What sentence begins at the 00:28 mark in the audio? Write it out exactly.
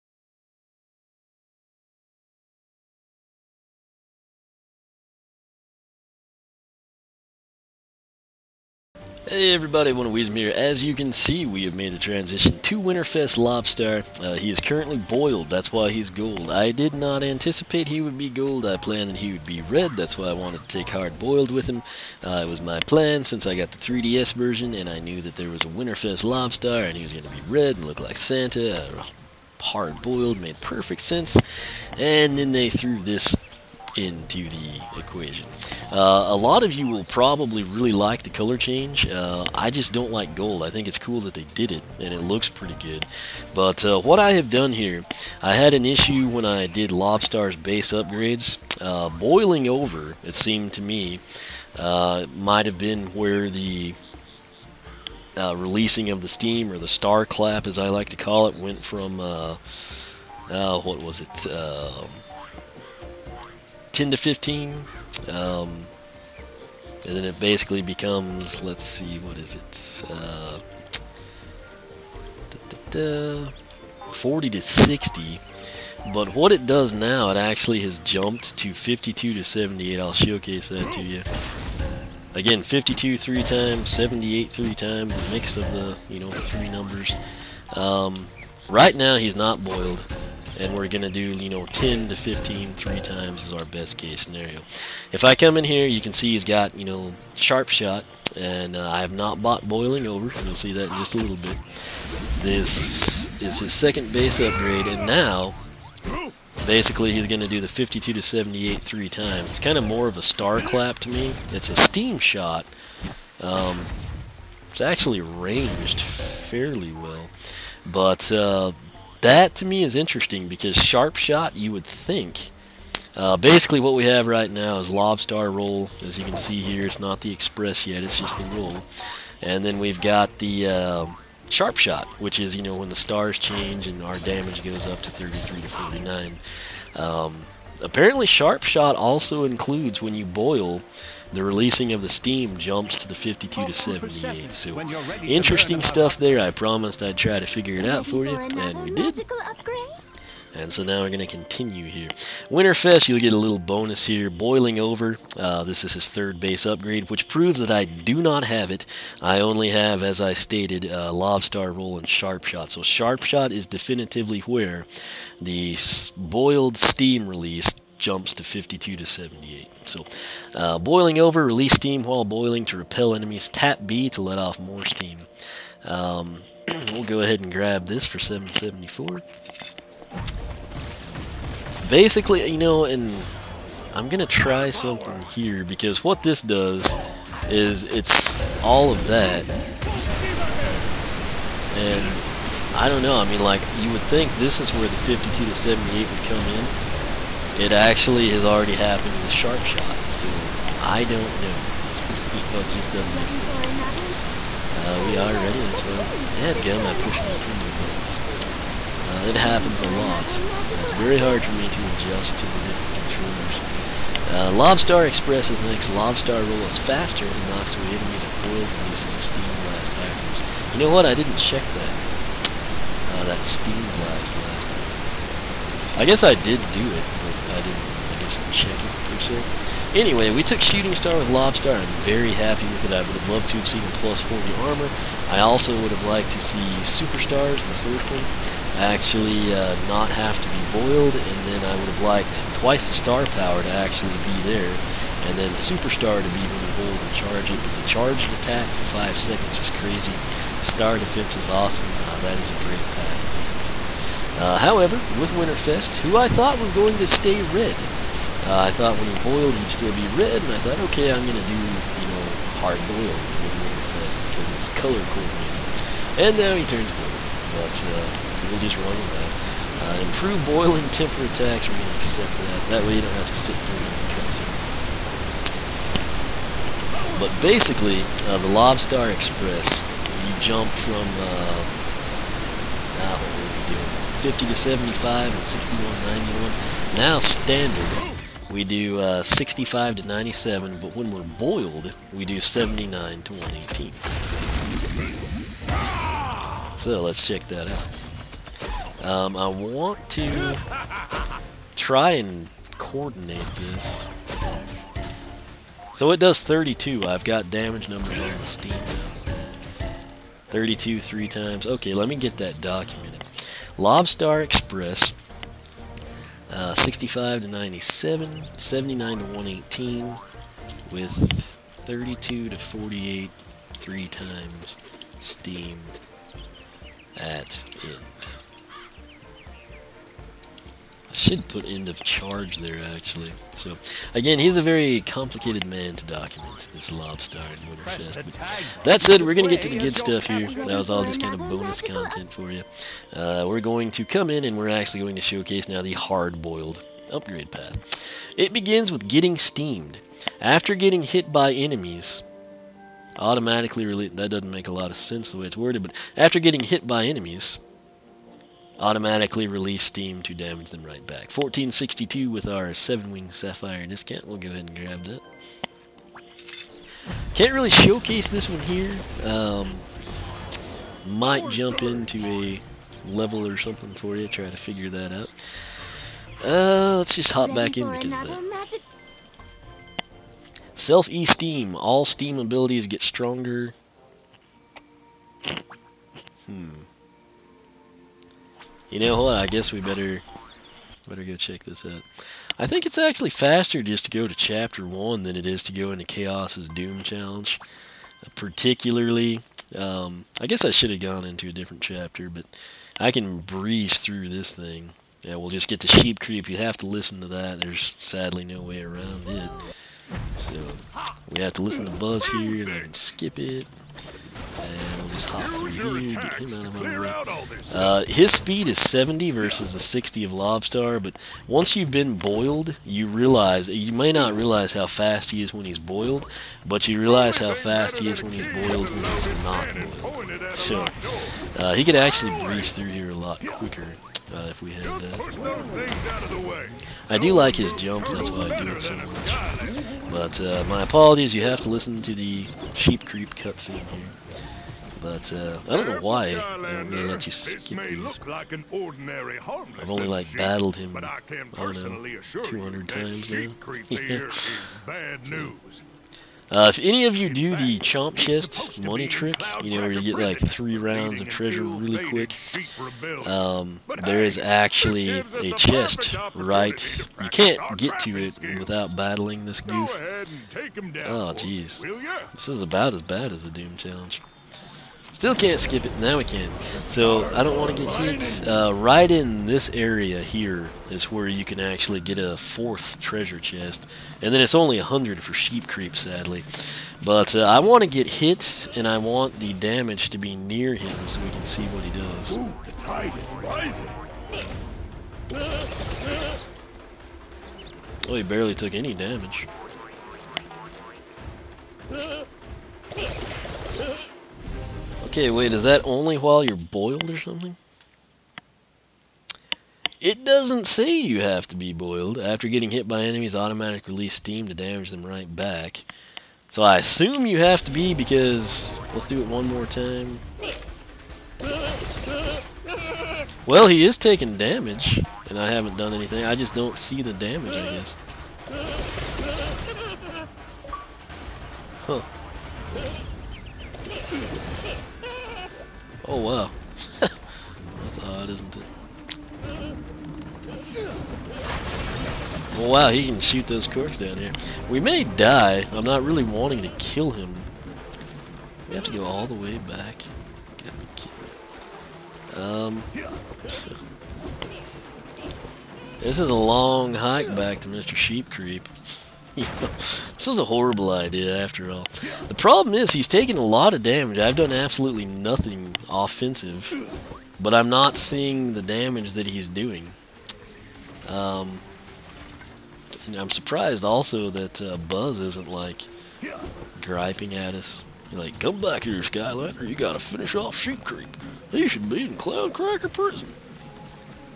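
Uh, hard boiled made perfect sense.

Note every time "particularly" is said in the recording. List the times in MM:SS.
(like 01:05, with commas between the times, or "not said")
06:38.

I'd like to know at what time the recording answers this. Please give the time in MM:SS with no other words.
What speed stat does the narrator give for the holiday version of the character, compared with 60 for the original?
06:58.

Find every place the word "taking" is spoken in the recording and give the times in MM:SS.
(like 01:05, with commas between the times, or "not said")
08:43, 09:23.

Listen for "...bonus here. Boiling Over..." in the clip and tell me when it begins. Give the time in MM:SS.
02:33.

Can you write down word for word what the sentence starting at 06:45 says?
Yeah, we'll just get to Sheep Creep.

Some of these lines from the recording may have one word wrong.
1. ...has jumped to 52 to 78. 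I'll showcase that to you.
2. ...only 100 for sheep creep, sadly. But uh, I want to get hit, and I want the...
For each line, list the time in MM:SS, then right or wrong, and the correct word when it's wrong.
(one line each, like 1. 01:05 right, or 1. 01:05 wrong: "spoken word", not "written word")
1. 01:17 right
2. 08:04 right.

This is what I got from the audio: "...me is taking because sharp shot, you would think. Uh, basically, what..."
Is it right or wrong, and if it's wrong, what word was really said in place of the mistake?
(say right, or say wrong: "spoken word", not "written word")
wrong: "interesting", not "taking".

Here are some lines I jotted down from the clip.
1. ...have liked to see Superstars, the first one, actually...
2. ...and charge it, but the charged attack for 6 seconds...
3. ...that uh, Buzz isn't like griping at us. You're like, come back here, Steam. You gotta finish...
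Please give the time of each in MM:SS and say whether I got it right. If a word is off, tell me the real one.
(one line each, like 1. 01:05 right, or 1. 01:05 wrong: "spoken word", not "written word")
1. 03:55 right
2. 04:07 wrong: "5", not "6"
3. 09:34 wrong: "Skylander", not "Steam".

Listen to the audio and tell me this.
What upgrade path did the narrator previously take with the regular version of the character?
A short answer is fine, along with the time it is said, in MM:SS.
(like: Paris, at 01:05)
Shooting Star, at 03:50.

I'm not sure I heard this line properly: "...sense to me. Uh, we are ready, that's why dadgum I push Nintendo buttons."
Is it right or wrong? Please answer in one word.
right.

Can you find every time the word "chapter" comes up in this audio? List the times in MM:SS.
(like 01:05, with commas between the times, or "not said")
06:34, 06:41.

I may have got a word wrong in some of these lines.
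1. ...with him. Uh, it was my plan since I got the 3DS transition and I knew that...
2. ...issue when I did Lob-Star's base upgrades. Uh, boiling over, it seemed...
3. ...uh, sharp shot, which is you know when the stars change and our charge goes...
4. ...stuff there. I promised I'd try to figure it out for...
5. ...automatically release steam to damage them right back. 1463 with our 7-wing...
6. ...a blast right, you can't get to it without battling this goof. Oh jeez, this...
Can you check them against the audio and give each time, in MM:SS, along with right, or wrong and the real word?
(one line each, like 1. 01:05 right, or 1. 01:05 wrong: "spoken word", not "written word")
1. 00:21 wrong: "version", not "transition"
2. 00:45 right
3. 02:10 wrong: "damage", not "charge"
4. 02:25 right
5. 05:58 wrong: "1462", not "1463"
6. 07:45 wrong: "chest", not "blast".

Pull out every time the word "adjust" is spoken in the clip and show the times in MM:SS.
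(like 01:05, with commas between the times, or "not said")
03:31.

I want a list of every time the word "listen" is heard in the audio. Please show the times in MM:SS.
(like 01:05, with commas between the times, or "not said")
06:46, 06:51, 07:21.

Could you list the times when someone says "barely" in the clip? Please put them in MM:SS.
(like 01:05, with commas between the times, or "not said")
08:18.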